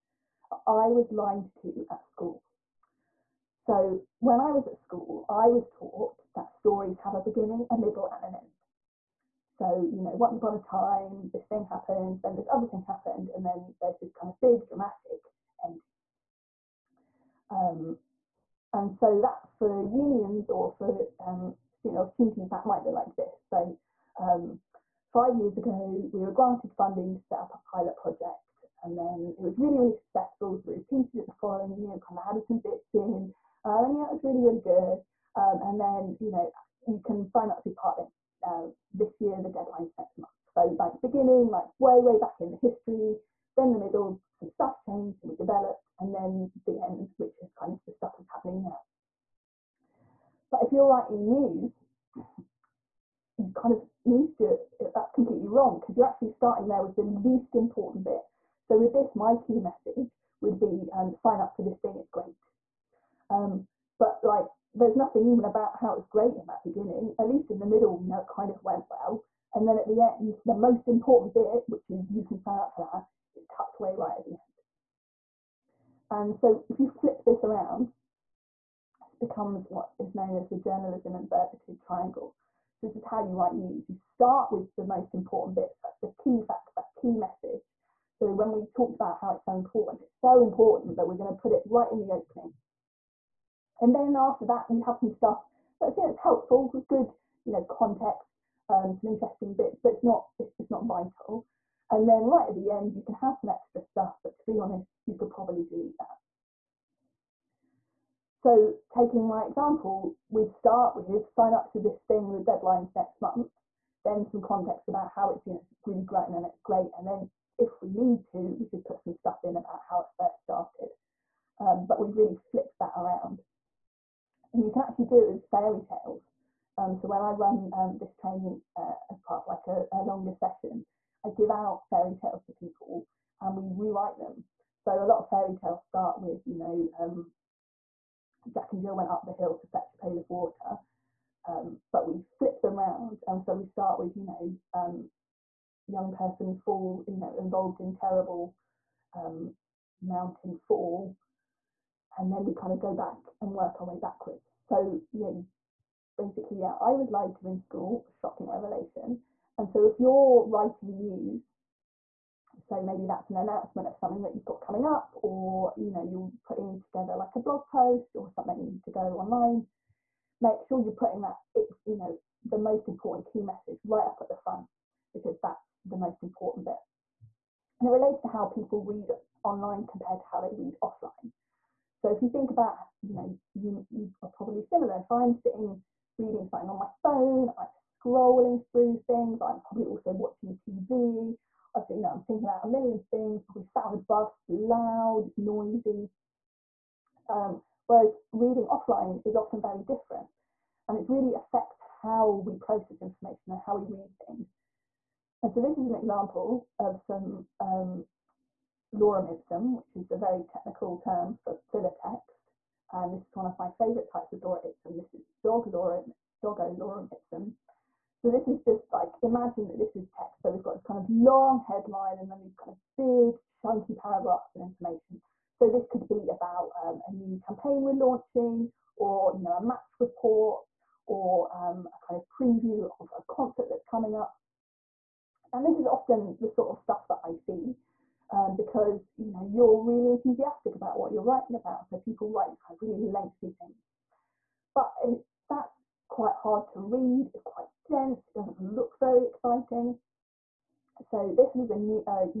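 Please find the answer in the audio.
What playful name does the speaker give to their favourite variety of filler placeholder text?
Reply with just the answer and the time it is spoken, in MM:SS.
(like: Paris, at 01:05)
doggo lorem ipsum, at 03:36.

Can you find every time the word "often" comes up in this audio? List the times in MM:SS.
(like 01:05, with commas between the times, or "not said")
03:19, 03:55.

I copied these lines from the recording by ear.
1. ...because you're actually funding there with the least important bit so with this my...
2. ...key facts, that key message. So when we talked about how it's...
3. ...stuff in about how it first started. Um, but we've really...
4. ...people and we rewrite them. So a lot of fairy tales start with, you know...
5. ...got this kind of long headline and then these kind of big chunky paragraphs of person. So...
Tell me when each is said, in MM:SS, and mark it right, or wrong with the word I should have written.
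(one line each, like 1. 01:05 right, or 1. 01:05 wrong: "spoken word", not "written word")
1. 00:55 wrong: "starting", not "funding"
2. 01:26 right
3. 01:59 right
4. 02:12 right
5. 03:40 wrong: "information", not "person".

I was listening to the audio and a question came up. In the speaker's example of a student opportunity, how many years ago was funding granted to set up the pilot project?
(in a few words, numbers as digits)
5.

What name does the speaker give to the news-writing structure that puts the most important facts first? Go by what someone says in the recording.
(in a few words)
journalism inverted triangle.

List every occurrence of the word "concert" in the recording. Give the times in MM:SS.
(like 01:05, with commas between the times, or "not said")
03:53.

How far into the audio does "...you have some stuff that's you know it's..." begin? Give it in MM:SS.
01:34.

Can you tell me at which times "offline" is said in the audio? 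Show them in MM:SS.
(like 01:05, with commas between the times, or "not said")
03:00, 03:18.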